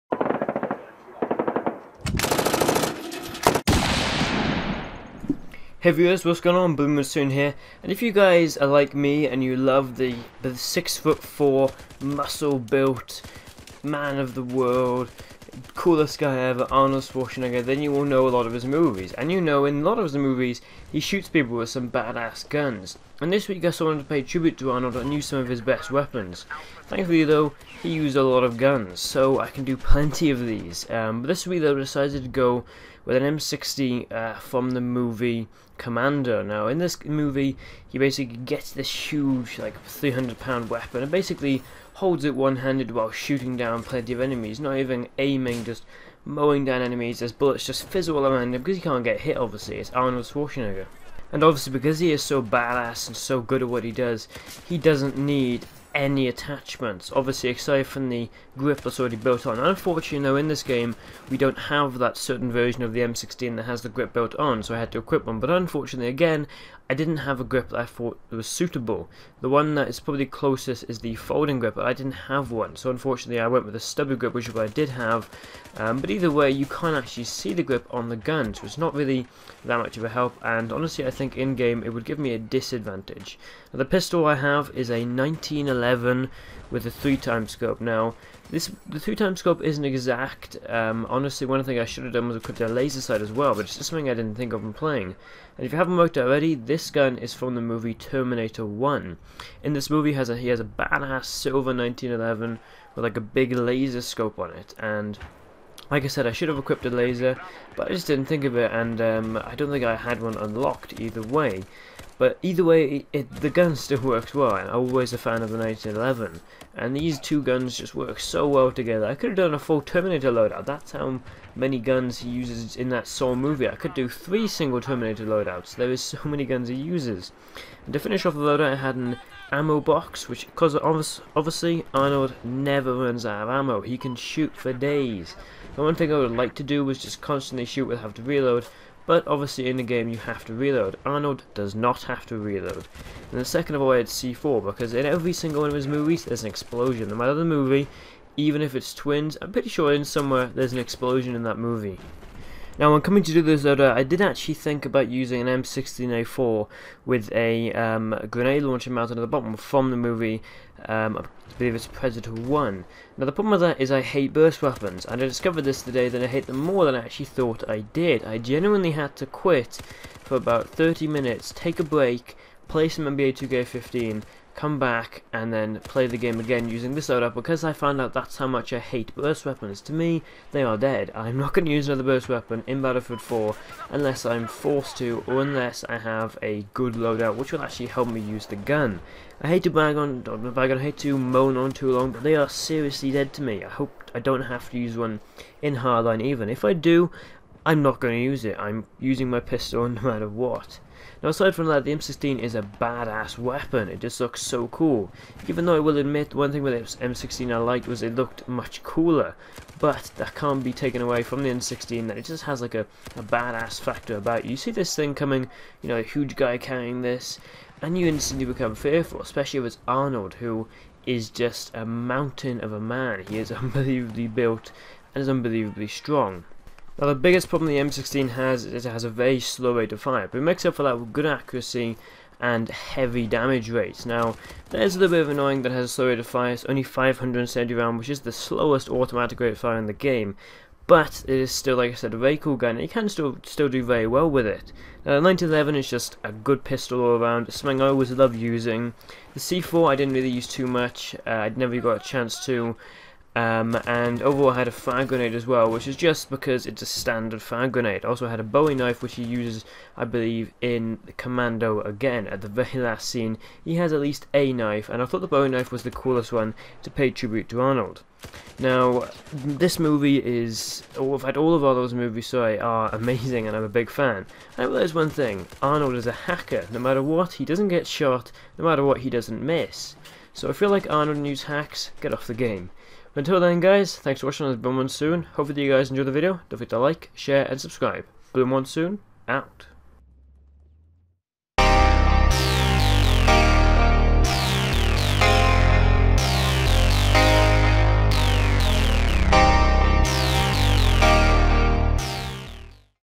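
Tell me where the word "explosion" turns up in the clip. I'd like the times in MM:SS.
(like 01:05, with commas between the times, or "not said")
02:26, 02:30.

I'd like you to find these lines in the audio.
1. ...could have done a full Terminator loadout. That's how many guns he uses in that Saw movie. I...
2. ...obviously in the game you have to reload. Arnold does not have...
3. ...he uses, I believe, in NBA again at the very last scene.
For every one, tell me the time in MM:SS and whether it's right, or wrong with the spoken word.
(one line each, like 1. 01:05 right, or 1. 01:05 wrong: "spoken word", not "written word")
1. 01:59 right
2. 02:19 right
3. 04:19 wrong: "Commando", not "NBA".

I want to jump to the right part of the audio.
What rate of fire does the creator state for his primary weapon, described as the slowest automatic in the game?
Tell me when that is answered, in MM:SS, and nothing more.
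03:56.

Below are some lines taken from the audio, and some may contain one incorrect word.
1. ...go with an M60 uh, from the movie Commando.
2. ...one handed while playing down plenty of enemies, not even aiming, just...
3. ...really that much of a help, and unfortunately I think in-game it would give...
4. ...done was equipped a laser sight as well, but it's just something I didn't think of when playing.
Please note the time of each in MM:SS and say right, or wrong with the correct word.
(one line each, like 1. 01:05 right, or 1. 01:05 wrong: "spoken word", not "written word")
1. 00:32 right
2. 00:42 wrong: "shooting", not "playing"
3. 01:18 wrong: "honestly", not "unfortunately"
4. 01:32 right.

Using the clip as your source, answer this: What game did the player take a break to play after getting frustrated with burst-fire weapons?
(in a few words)
NBA 2K15.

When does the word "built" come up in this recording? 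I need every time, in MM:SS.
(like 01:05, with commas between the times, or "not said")
00:12, 00:59, 01:04, 03:44.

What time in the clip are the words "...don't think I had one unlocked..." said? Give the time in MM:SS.
01:49.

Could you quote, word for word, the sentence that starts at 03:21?
Now aside from that, the M16 is a badass weapon.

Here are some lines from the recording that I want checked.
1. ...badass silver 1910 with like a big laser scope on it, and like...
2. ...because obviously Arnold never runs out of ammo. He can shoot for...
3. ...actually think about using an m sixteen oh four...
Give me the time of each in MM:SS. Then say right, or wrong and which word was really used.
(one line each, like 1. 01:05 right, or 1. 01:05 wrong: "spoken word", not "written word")
1. 01:40 wrong: "1911", not "1910"
2. 02:10 right
3. 02:34 right.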